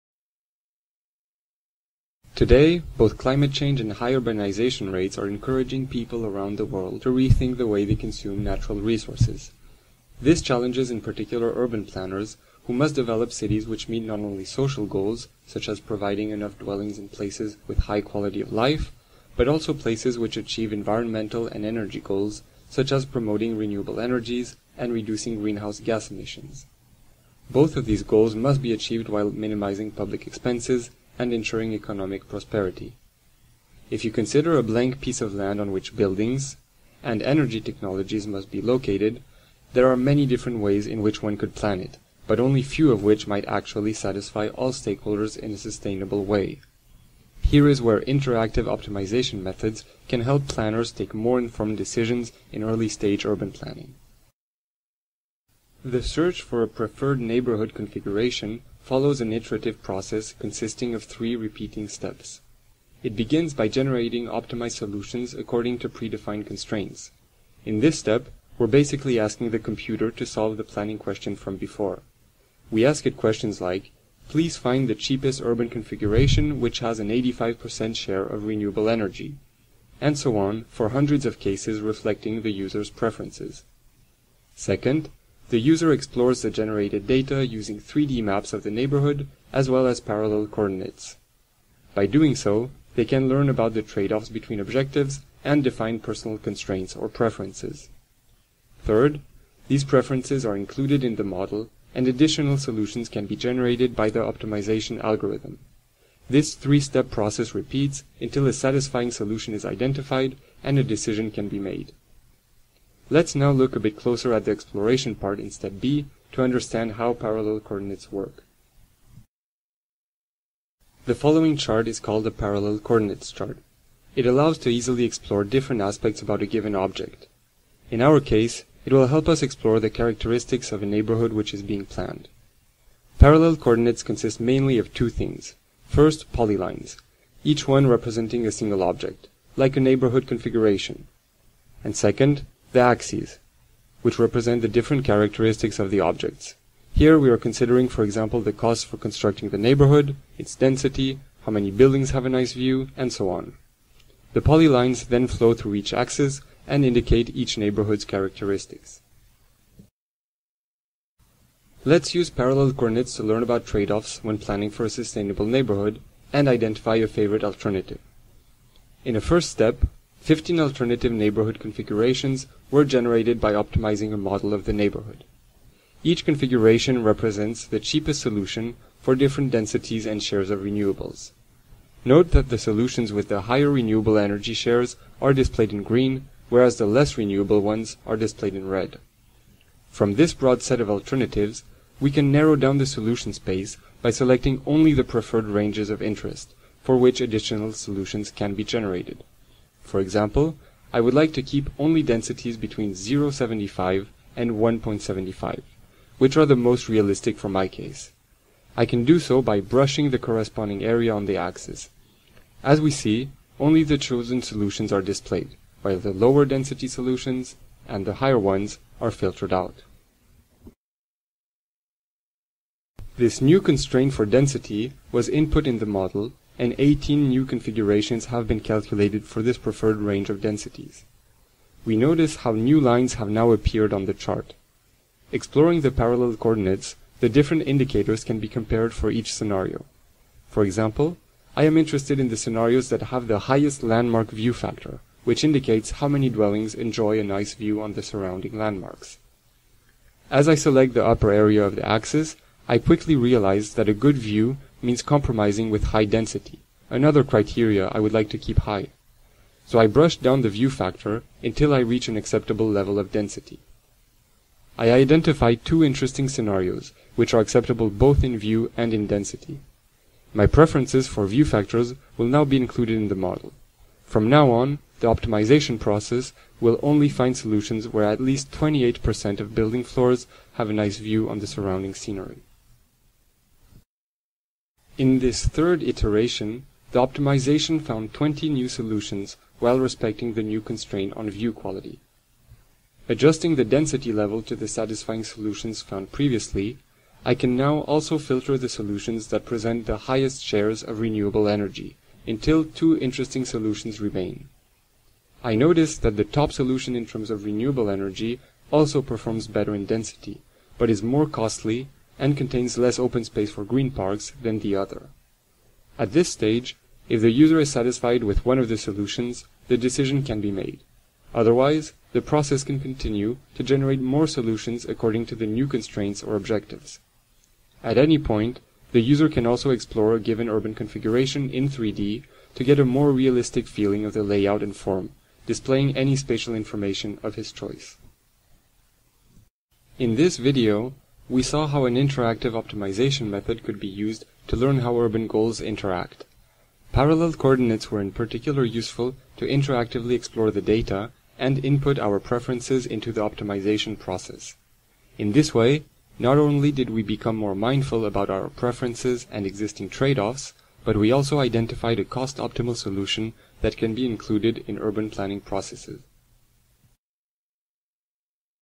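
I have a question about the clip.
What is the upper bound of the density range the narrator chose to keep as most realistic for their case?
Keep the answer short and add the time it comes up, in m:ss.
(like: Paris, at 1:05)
1.75, at 3:24.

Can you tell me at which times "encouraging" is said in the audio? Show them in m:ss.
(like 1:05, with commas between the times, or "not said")
0:05.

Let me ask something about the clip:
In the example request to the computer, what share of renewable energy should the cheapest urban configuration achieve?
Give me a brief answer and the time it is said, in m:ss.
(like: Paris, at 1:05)
85%, at 1:17.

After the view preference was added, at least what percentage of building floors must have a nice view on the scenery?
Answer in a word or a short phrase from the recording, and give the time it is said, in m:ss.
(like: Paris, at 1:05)
28%, at 4:38.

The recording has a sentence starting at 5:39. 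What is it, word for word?
In this video, we saw how an interactive optimization method could be used to learn how urban goals interact.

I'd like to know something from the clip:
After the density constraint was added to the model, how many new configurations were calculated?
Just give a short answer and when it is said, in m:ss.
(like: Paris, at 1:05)
18, at 3:46.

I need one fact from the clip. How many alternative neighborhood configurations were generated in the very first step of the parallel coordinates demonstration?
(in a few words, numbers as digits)
15.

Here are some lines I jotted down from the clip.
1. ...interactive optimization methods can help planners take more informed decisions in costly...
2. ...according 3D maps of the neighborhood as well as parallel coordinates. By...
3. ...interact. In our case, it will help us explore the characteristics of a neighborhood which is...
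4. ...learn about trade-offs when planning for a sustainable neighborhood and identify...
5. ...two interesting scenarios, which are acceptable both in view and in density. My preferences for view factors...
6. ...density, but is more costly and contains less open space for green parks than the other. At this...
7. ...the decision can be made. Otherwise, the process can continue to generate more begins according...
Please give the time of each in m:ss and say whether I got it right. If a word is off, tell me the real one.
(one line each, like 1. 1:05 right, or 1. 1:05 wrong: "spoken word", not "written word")
1. 0:48 wrong: "early", not "costly"
2. 1:27 wrong: "using", not "according"
3. 2:06 wrong: "object", not "interact"
4. 2:43 right
5. 4:25 right
6. 5:09 right
7. 5:19 wrong: "solutions", not "begins".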